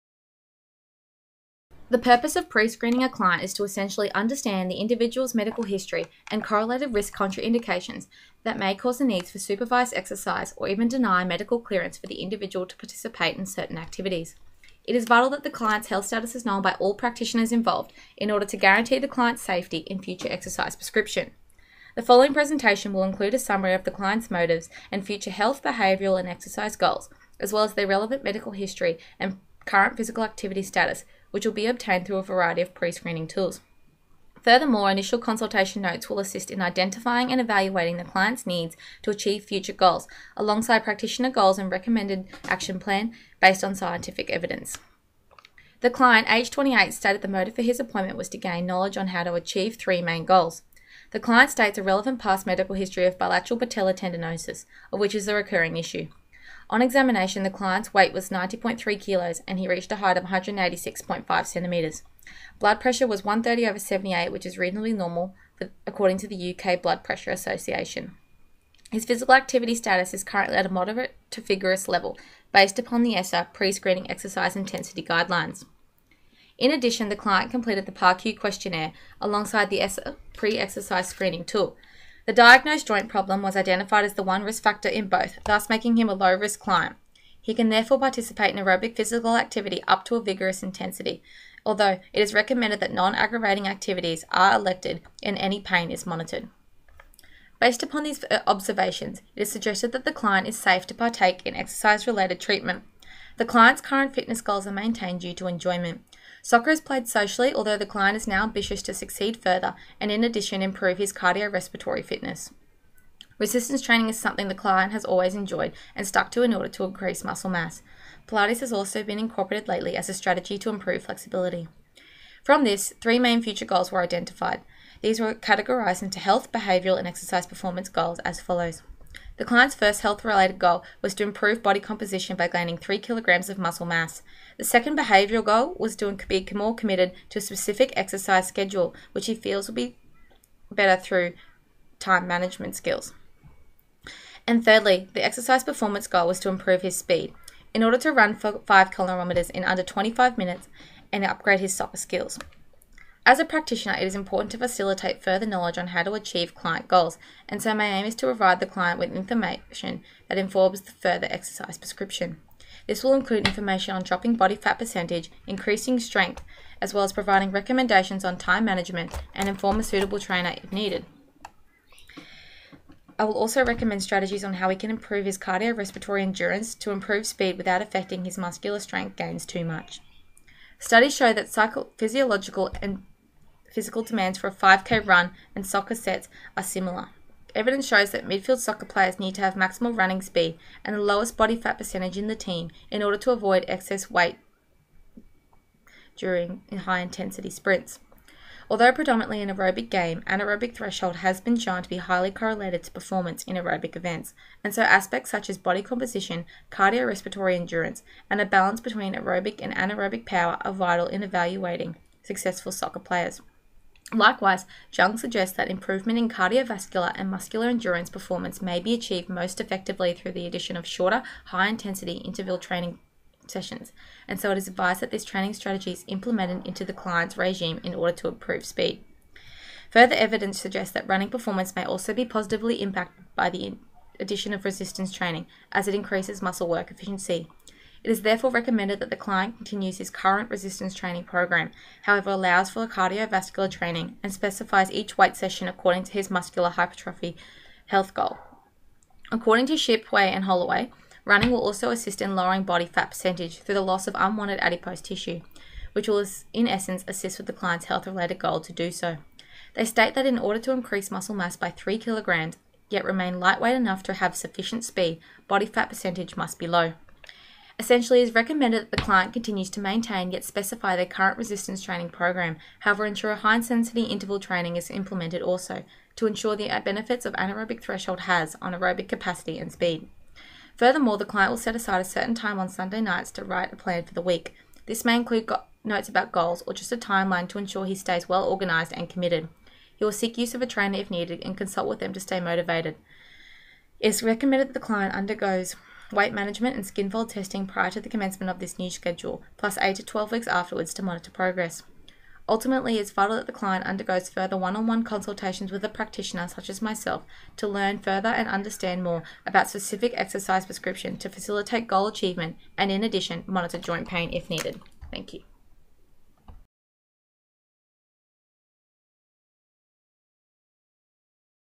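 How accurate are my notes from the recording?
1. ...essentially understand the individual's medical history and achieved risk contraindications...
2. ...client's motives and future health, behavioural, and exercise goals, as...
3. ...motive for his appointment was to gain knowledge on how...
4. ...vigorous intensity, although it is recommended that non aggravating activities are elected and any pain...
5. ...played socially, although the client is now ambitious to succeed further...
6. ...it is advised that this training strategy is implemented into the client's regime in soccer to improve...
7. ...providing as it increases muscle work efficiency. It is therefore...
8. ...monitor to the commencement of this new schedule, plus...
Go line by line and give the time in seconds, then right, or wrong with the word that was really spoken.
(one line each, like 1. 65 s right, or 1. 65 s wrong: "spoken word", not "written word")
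1. 3 s wrong: "correlated", not "achieved"
2. 23 s right
3. 47 s right
4. 90 s right
5. 106 s right
6. 224 s wrong: "order", not "soccer"
7. 235 s wrong: "training", not "providing"
8. 297 s wrong: "prior", not "monitor".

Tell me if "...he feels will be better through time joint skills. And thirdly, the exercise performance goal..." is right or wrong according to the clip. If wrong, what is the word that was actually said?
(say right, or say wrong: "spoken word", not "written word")
wrong: "management", not "joint".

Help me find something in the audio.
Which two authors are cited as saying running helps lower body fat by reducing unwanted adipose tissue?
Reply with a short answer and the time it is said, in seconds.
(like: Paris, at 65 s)
Shipway and Holloway, at 249 s.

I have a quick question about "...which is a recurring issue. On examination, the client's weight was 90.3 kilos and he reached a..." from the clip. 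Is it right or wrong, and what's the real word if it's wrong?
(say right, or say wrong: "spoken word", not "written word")
right.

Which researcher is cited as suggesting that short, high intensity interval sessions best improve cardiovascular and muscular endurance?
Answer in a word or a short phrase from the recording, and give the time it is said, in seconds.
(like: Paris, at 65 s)
Jung, at 214 s.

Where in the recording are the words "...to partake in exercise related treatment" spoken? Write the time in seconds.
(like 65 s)
100 s.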